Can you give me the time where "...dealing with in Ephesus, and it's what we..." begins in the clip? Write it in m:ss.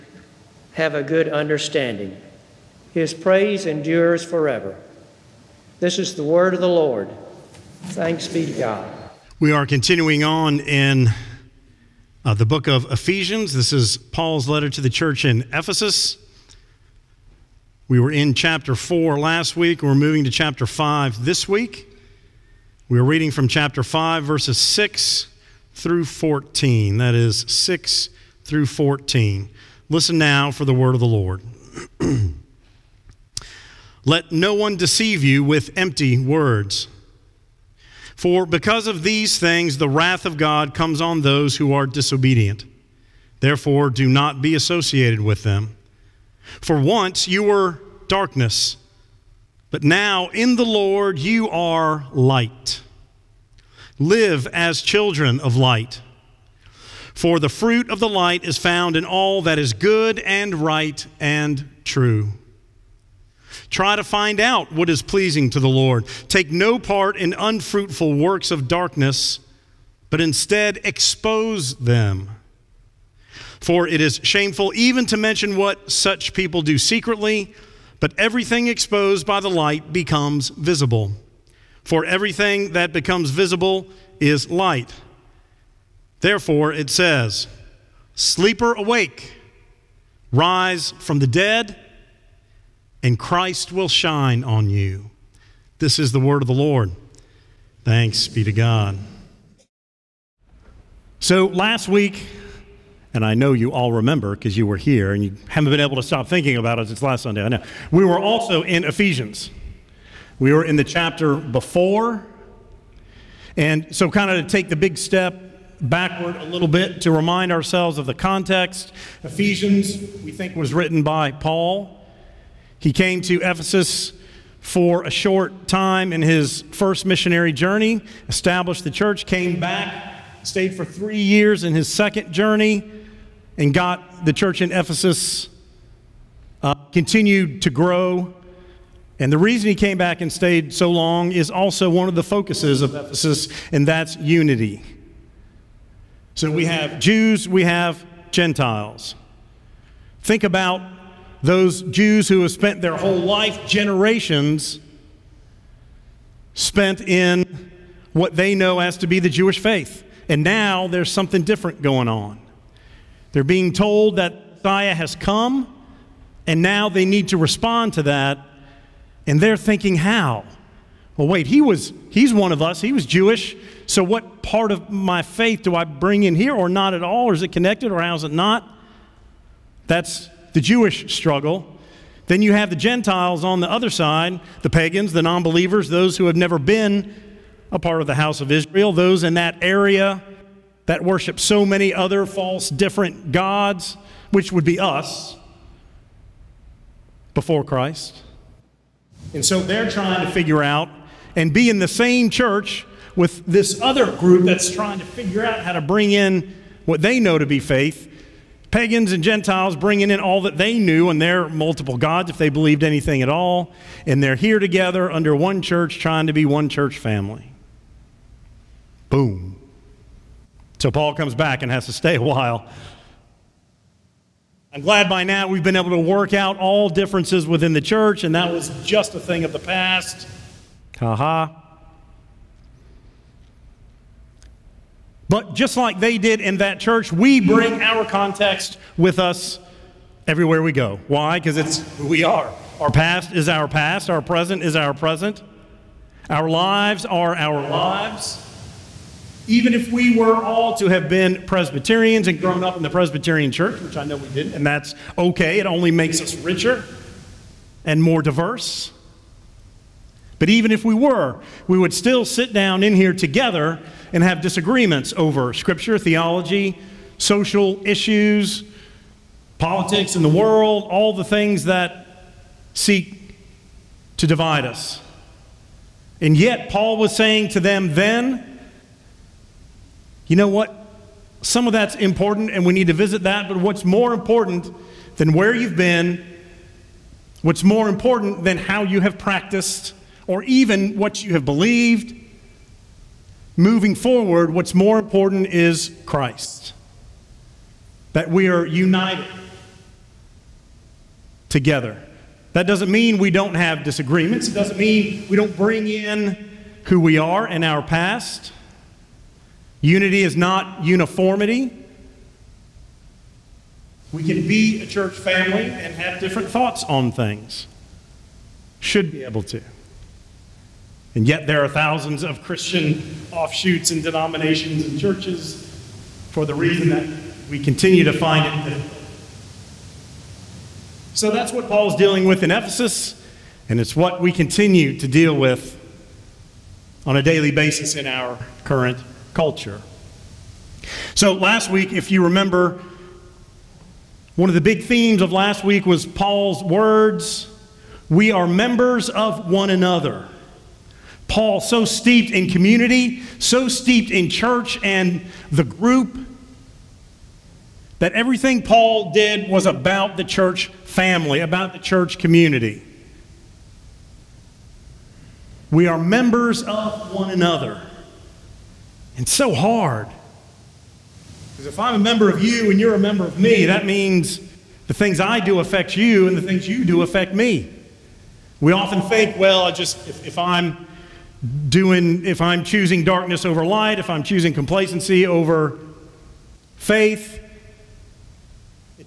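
5:31.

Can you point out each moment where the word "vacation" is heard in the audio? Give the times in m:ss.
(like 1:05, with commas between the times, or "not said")
not said.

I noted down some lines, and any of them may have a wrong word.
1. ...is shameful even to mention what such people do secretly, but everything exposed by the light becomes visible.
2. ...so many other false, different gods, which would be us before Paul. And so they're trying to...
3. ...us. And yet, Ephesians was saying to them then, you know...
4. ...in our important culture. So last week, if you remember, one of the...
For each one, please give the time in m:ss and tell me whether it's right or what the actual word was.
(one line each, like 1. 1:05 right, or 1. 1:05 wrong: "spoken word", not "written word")
1. 1:14 right
2. 3:11 wrong: "Christ", not "Paul"
3. 4:34 wrong: "Paul", not "Ephesians"
4. 5:37 wrong: "current", not "important".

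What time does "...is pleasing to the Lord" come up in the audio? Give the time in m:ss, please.
1:04.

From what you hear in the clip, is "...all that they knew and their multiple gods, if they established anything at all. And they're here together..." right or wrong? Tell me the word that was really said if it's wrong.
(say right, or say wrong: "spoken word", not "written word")
wrong: "believed", not "established".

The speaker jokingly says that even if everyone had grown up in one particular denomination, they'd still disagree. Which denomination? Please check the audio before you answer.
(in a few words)
Presbyterian.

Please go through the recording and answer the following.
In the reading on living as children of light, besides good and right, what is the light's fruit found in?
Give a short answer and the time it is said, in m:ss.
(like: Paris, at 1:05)
True, at 1:01.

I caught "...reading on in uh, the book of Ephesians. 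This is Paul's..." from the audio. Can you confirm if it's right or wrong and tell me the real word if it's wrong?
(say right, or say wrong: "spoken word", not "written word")
wrong: "continuing", not "reading".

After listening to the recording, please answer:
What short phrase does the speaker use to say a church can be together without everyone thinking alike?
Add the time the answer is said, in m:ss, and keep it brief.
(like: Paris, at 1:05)
Unity is not uniformity, at 5:09.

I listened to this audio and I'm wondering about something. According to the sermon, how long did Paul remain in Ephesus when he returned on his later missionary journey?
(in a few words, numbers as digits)
3 years.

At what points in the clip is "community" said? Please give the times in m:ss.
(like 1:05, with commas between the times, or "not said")
5:52, 6:02.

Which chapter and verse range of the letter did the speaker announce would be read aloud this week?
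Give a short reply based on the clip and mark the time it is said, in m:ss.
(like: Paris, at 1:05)
Verses 6 through 14, at 0:24.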